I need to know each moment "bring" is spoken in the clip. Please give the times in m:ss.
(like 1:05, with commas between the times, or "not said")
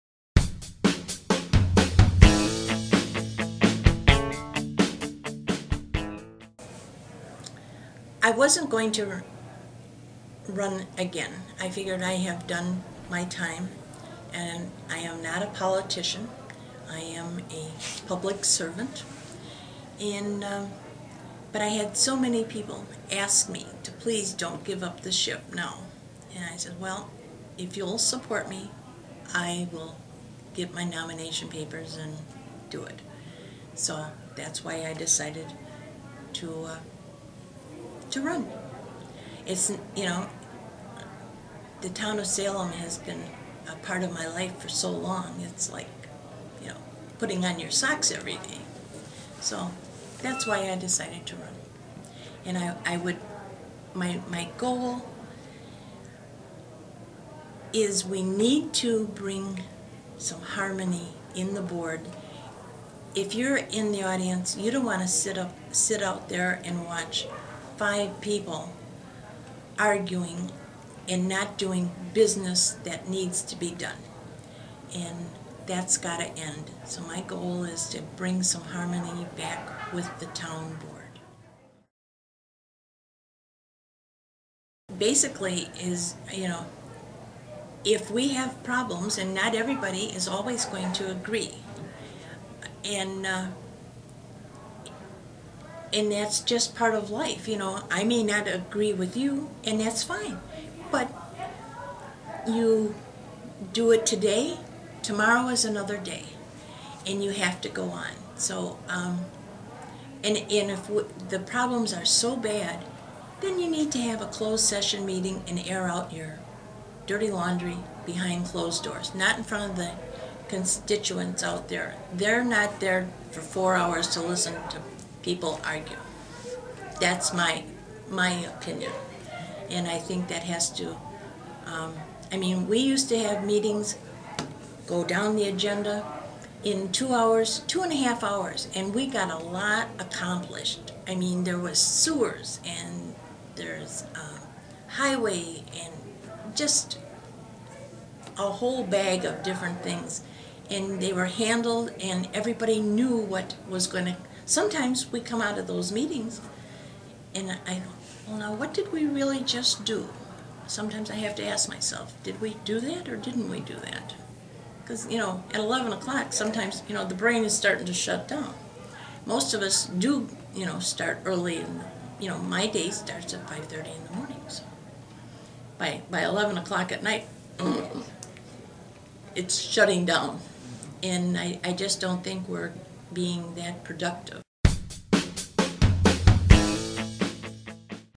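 0:59, 1:18.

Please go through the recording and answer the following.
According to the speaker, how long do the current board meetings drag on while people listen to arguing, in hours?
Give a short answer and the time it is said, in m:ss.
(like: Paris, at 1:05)
4, at 2:03.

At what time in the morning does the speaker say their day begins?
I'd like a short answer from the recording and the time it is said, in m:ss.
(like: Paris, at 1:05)
5:30, at 2:53.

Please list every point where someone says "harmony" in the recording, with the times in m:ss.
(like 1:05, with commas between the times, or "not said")
1:00, 1:18.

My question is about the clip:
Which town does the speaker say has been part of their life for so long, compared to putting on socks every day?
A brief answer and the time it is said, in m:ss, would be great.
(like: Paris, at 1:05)
Salem, at 0:42.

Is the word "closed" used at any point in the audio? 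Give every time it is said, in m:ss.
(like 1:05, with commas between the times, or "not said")
1:54, 1:58.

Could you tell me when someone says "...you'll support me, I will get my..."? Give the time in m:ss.
0:27.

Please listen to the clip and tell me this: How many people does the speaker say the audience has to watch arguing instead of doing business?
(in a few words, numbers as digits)
5.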